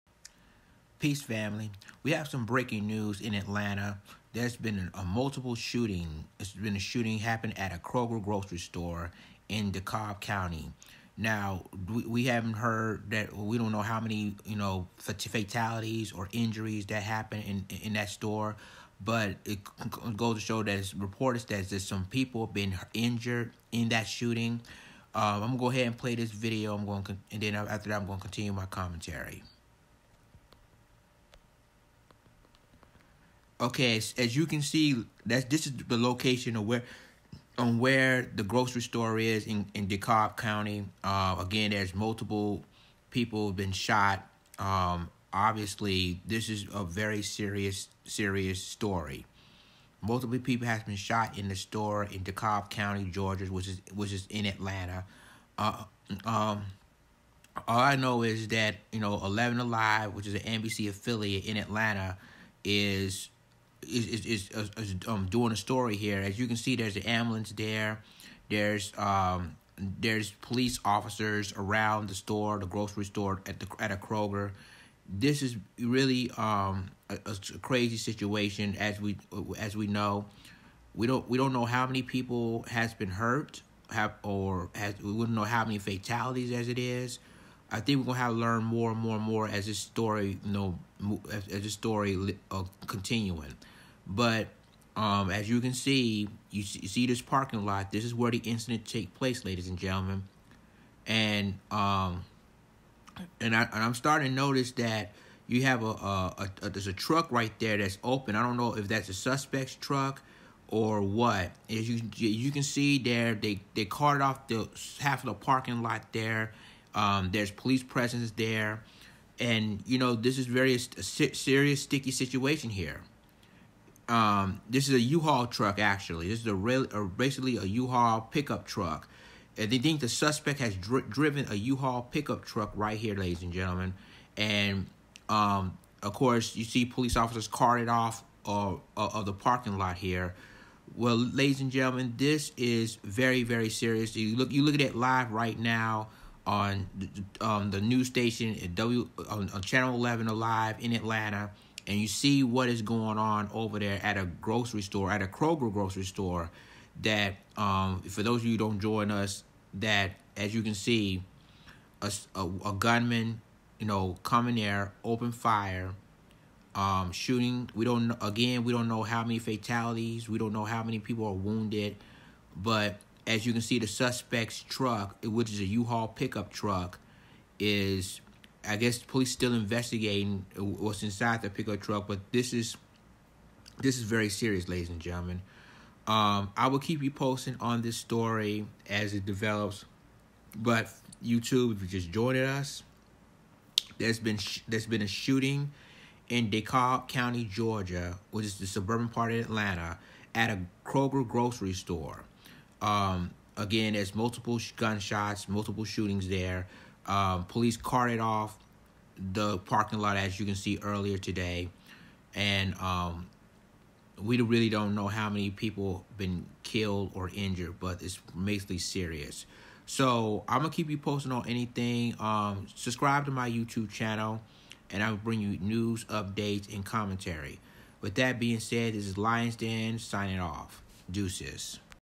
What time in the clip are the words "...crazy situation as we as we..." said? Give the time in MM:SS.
01:17.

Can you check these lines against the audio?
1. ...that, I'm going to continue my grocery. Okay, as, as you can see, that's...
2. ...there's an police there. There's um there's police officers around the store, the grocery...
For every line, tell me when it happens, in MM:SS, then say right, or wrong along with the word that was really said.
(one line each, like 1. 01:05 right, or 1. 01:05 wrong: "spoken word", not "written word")
1. 00:27 wrong: "commentary", not "grocery"
2. 01:06 wrong: "ambulance", not "police".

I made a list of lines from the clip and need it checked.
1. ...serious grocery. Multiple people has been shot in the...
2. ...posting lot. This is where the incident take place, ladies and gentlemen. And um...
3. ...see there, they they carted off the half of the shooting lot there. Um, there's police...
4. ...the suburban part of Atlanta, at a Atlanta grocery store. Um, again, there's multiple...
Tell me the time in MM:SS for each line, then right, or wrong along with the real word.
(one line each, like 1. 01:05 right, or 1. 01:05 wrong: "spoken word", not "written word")
1. 00:48 wrong: "story", not "grocery"
2. 01:37 wrong: "parking", not "posting"
3. 01:52 wrong: "parking", not "shooting"
4. 03:18 wrong: "Kroger", not "Atlanta".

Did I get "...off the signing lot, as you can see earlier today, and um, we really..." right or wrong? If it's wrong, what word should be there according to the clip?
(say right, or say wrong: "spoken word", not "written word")
wrong: "parking", not "signing".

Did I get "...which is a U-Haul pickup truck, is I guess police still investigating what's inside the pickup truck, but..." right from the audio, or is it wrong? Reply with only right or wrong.
right.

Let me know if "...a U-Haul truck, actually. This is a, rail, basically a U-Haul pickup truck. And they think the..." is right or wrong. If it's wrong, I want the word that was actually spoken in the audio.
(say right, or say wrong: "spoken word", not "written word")
right.